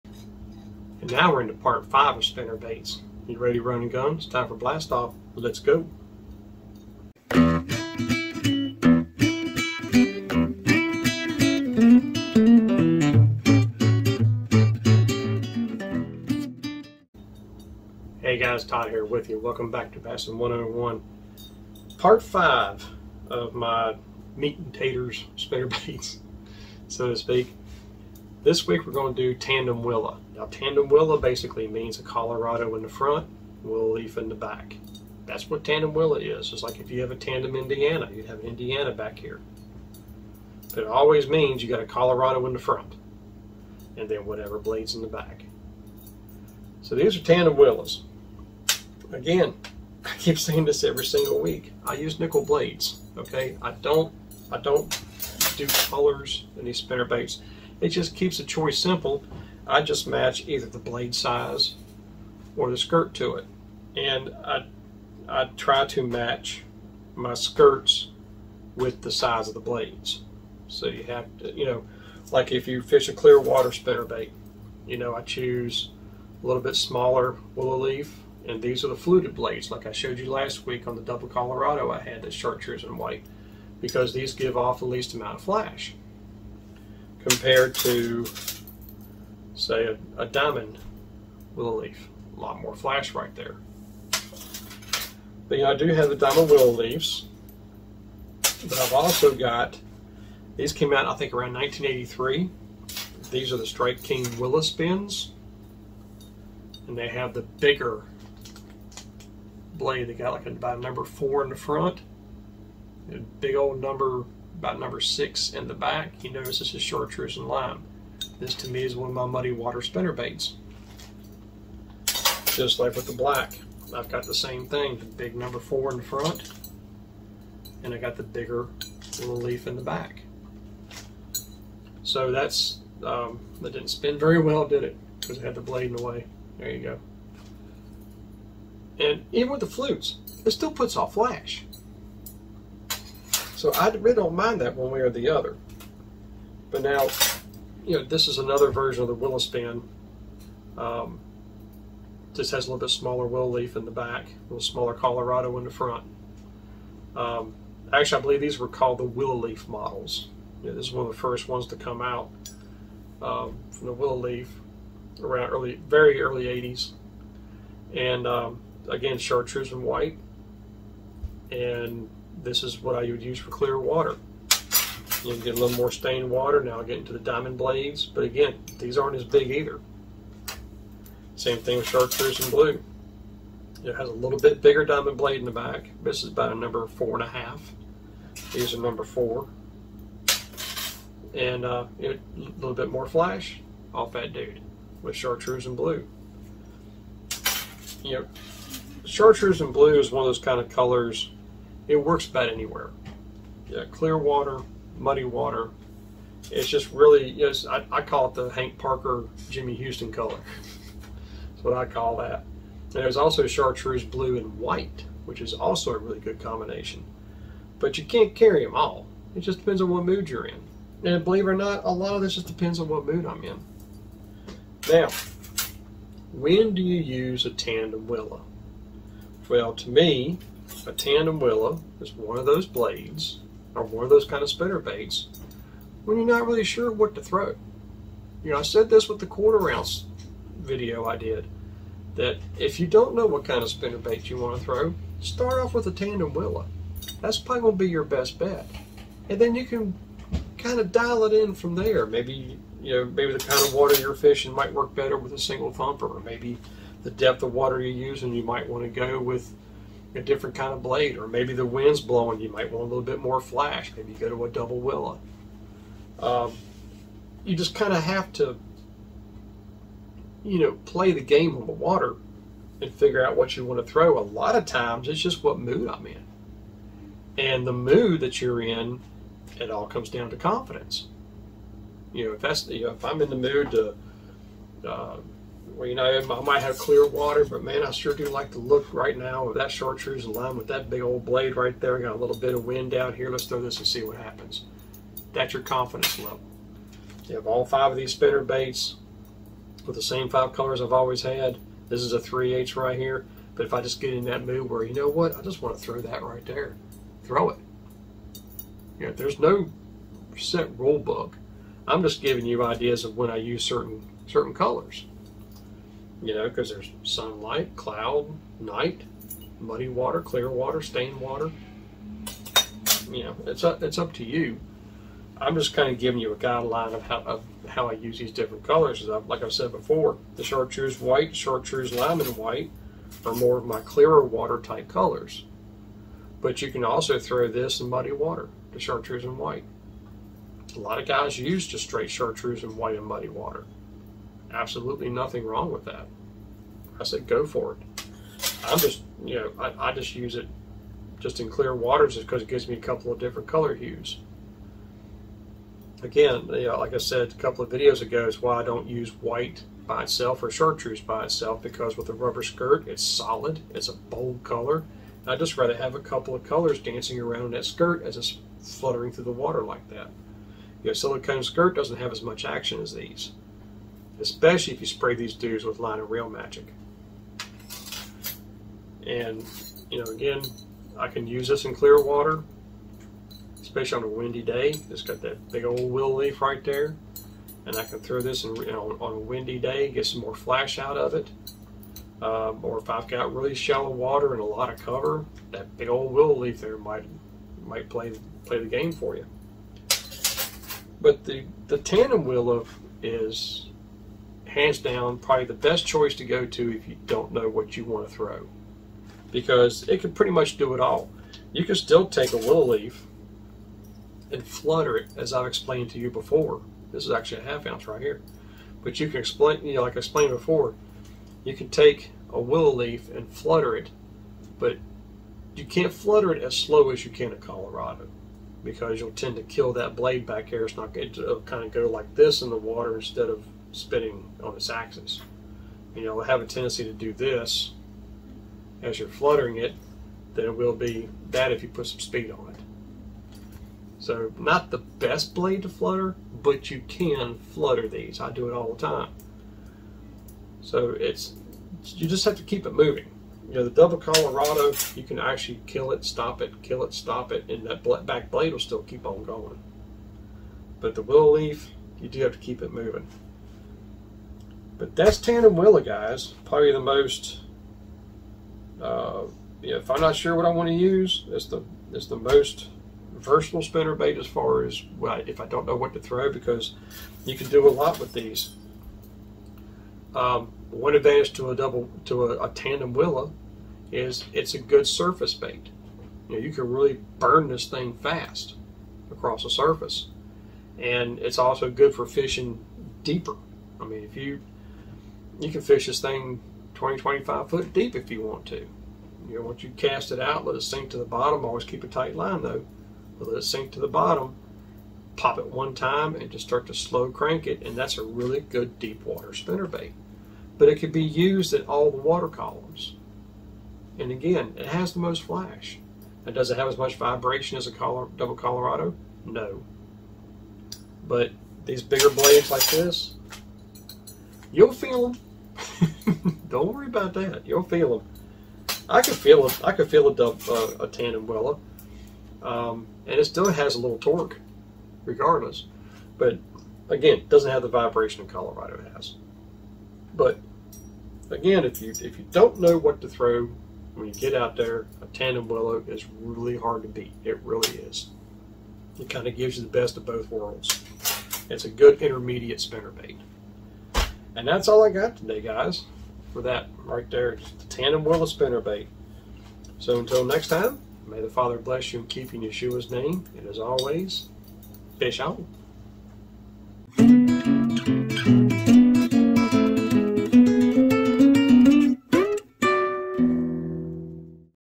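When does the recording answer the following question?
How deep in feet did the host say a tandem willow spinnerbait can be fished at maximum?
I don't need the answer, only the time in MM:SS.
08:16.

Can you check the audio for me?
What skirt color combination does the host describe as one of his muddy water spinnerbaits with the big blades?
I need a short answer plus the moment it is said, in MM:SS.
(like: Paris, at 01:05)
Chartreuse and lime, at 01:56.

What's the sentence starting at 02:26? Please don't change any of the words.
But now, you know, this is another version of the willow span.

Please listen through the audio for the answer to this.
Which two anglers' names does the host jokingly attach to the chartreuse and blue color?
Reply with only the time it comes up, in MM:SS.
03:28.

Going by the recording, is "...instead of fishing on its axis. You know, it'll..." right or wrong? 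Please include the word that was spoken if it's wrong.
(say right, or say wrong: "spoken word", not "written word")
wrong: "spinning", not "fishing".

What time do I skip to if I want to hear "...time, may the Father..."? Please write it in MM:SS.
09:20.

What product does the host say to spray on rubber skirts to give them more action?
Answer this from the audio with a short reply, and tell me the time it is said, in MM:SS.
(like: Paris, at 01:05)
Line and reel magic, at 06:15.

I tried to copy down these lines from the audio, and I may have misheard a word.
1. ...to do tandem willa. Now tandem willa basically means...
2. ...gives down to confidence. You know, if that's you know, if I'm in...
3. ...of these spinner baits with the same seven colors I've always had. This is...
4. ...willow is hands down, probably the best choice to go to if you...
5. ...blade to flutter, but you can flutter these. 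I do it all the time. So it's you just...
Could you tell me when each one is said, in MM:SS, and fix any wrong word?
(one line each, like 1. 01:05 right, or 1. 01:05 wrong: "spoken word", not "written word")
1. 00:29 right
2. 04:39 wrong: "comes", not "gives"
3. 04:57 wrong: "five", not "seven"
4. 06:42 right
5. 07:25 right.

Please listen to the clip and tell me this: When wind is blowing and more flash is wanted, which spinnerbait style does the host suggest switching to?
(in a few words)
Double willow.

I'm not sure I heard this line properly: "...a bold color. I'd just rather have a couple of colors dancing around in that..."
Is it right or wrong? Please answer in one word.
right.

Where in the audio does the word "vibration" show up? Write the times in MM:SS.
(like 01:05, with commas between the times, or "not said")
08:36, 08:57.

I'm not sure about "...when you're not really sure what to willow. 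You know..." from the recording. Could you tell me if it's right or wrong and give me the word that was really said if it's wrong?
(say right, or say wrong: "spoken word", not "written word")
wrong: "throw", not "willow".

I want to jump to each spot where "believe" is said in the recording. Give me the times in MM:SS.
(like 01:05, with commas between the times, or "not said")
02:38, 03:41.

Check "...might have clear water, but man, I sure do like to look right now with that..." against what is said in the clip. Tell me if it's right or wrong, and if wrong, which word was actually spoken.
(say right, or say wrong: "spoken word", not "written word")
right.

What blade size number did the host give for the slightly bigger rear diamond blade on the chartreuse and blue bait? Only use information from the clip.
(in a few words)
4.5.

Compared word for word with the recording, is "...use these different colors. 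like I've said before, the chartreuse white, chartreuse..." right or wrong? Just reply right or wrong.
right.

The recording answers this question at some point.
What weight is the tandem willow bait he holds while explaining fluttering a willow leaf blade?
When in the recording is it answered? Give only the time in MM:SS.
06:57.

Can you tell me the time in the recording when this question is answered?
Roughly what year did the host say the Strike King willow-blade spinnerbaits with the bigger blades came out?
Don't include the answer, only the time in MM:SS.
01:41.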